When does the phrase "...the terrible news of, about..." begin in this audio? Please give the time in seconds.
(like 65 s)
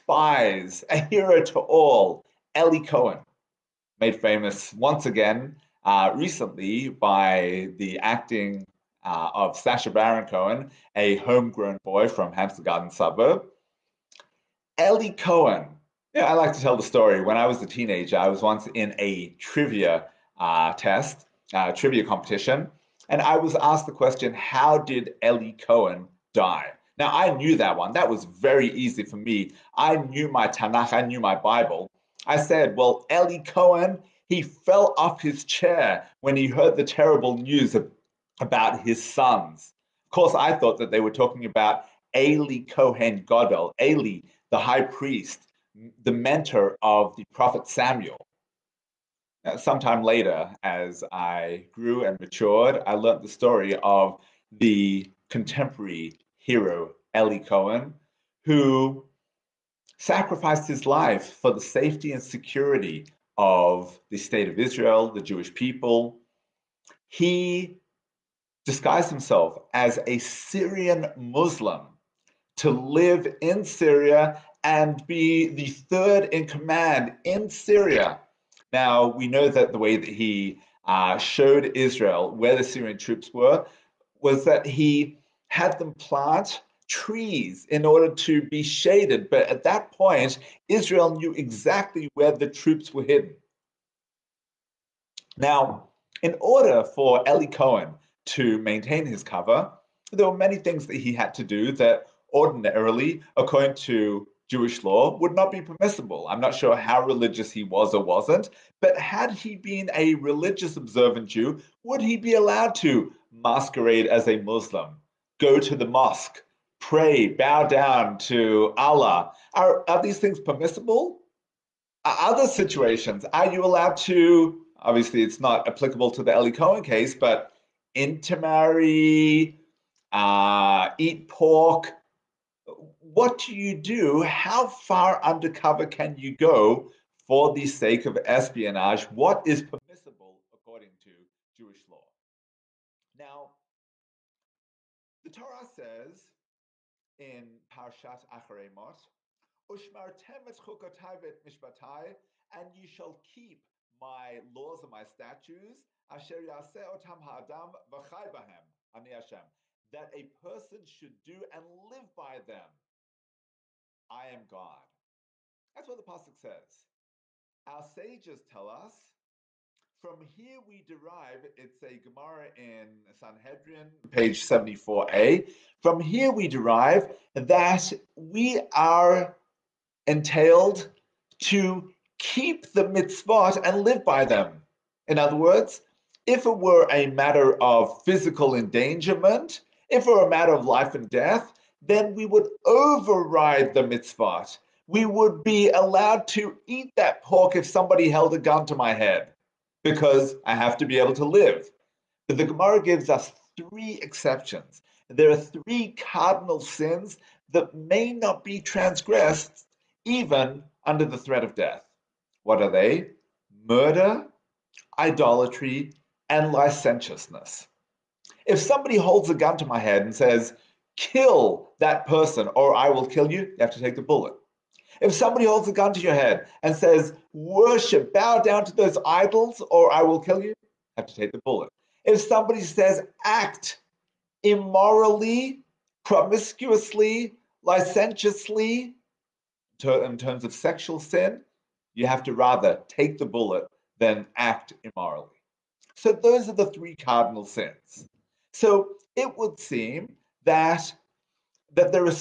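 36 s.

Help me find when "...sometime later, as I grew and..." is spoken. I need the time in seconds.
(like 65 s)
49 s.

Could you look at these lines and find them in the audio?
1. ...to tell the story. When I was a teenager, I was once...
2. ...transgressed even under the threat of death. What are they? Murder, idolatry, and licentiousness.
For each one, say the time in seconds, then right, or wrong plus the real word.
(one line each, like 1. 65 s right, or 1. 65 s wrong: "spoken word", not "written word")
1. 16 s right
2. 208 s right.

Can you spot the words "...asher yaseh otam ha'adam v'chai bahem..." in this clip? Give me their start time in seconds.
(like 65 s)
156 s.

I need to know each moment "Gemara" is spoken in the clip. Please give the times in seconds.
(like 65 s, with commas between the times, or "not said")
171 s, 202 s.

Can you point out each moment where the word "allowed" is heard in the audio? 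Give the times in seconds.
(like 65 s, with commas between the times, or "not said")
112 s, 123 s, 195 s.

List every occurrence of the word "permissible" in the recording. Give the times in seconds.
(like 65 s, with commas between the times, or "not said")
105 s, 120 s, 139 s.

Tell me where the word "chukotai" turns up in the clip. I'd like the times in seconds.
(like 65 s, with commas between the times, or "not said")
150 s.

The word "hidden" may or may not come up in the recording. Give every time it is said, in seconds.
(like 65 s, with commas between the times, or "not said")
93 s.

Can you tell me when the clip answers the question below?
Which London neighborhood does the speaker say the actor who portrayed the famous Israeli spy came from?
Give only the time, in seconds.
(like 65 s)
12 s.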